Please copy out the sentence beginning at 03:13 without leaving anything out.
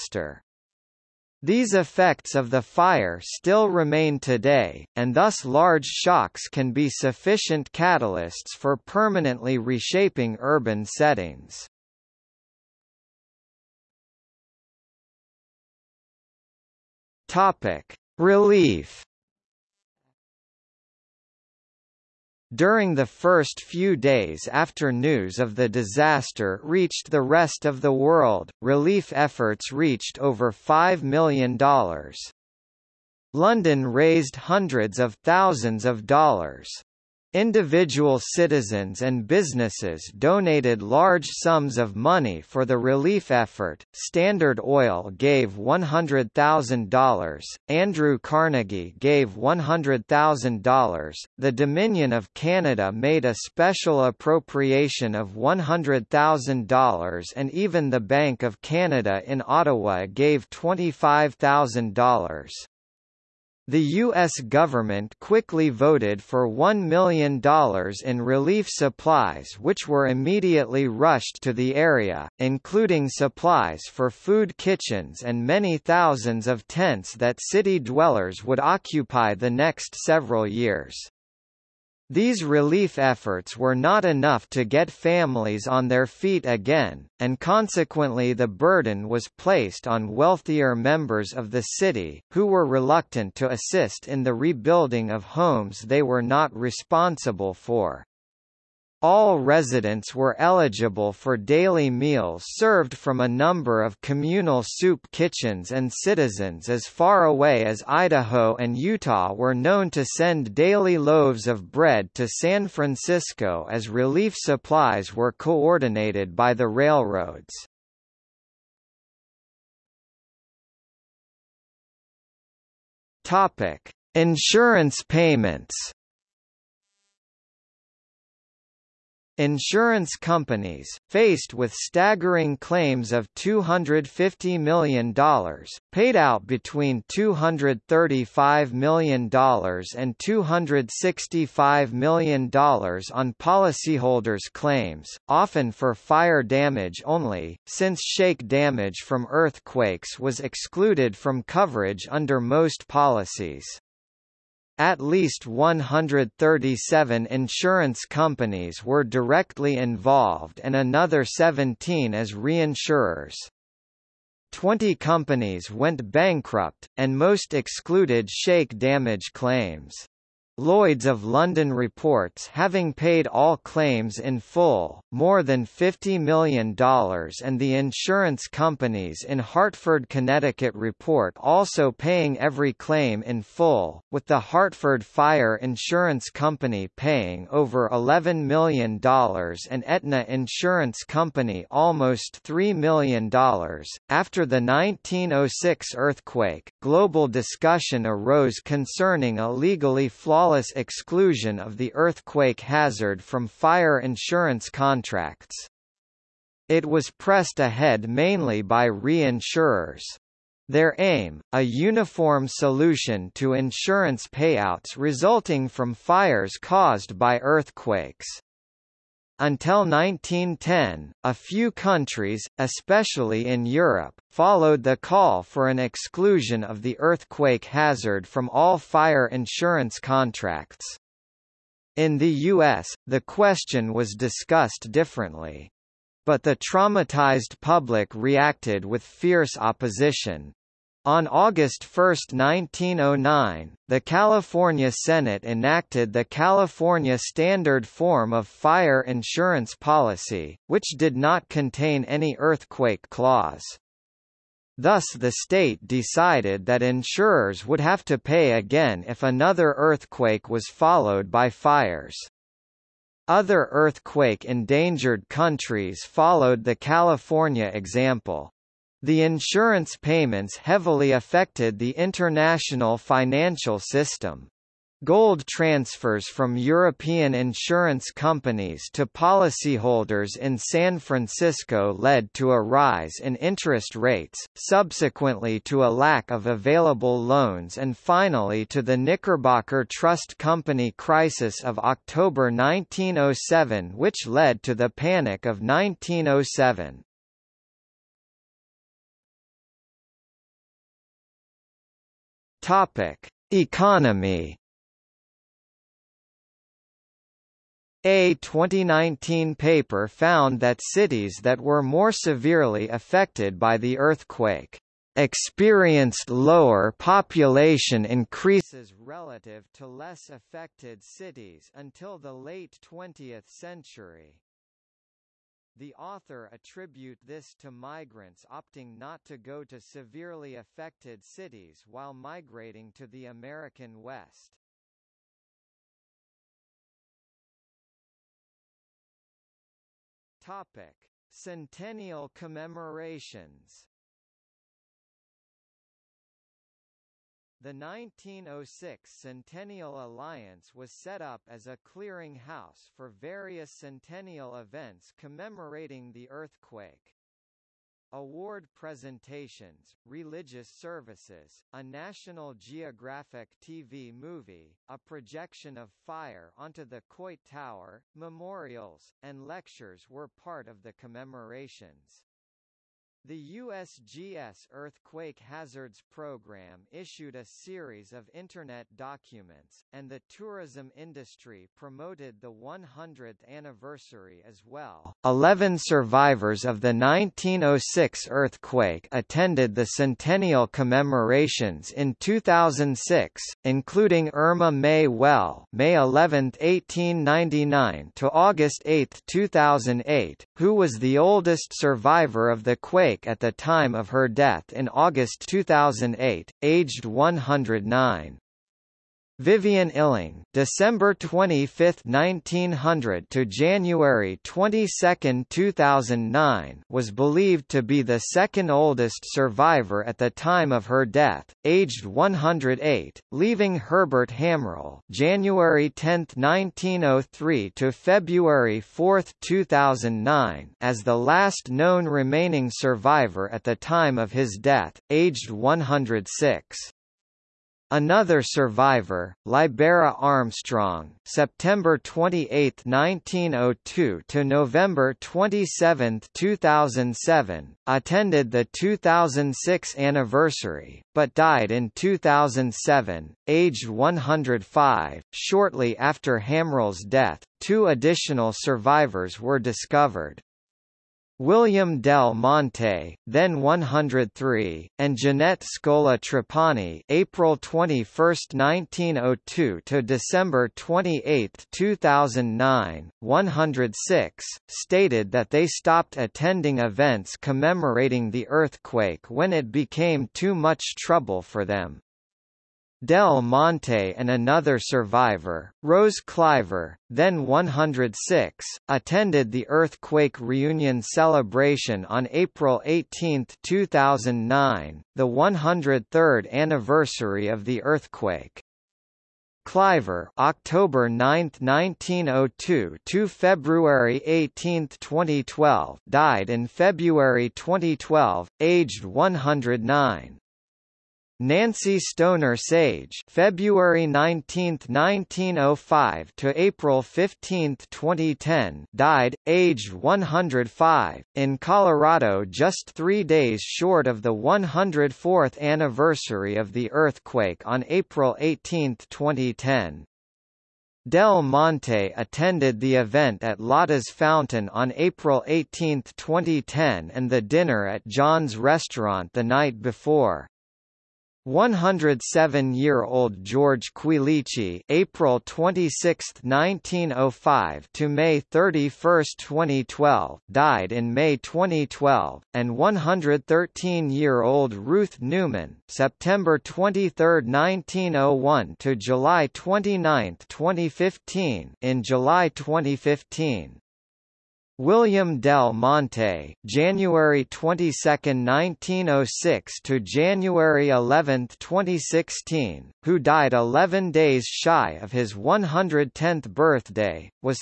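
After the 1906 earthquake, global discussion arose concerning a legally flawed Wallace exclusion of the earthquake hazard from fire insurance contracts.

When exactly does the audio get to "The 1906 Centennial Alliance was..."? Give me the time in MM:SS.
05:47.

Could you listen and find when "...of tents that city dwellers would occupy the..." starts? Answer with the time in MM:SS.
01:16.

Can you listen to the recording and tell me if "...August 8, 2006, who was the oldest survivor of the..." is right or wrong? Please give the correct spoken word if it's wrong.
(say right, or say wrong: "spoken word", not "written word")
wrong: "2008", not "2006".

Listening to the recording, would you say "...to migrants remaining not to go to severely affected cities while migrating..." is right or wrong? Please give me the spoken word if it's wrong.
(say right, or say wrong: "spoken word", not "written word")
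wrong: "opting", not "remaining".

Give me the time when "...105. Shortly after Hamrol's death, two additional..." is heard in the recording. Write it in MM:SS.
07:33.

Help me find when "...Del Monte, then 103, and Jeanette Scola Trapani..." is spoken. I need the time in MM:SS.
07:41.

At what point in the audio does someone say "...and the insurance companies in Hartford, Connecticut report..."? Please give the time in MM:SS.
02:56.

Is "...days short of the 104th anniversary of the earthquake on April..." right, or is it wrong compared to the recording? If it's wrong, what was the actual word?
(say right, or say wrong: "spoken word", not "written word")
right.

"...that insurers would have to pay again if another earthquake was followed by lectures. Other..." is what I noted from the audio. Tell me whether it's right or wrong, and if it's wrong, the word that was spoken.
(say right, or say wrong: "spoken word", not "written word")
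wrong: "fires", not "lectures".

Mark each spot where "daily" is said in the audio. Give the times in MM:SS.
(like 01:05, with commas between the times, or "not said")
01:41, 01:50.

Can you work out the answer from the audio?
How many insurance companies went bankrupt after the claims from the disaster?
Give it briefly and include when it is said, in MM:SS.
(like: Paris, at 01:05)
20, at 02:44.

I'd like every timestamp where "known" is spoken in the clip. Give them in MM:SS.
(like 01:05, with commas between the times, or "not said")
01:49, 07:11.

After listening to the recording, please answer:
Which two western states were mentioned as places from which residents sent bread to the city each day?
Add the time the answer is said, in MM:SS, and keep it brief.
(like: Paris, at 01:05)
Idaho and Utah, at 01:47.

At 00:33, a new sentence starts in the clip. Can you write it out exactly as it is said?
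London raised hundreds of thousands of dollars.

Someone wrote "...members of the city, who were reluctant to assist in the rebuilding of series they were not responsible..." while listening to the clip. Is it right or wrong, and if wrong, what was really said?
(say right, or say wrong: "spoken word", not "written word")
wrong: "homes", not "series".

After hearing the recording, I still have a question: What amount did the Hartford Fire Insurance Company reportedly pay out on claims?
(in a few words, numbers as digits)
over $11 million.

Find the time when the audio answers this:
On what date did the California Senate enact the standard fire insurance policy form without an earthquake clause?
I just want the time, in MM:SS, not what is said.
04:01.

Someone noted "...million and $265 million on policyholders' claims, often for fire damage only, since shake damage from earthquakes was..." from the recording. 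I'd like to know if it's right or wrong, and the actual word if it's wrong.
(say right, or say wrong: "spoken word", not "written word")
right.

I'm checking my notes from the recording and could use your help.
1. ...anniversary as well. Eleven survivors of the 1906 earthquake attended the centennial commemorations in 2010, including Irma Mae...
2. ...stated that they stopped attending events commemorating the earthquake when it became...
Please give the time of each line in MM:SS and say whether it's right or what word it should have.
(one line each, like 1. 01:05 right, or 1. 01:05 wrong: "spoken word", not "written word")
1. 06:23 wrong: "2006", not "2010"
2. 07:54 right.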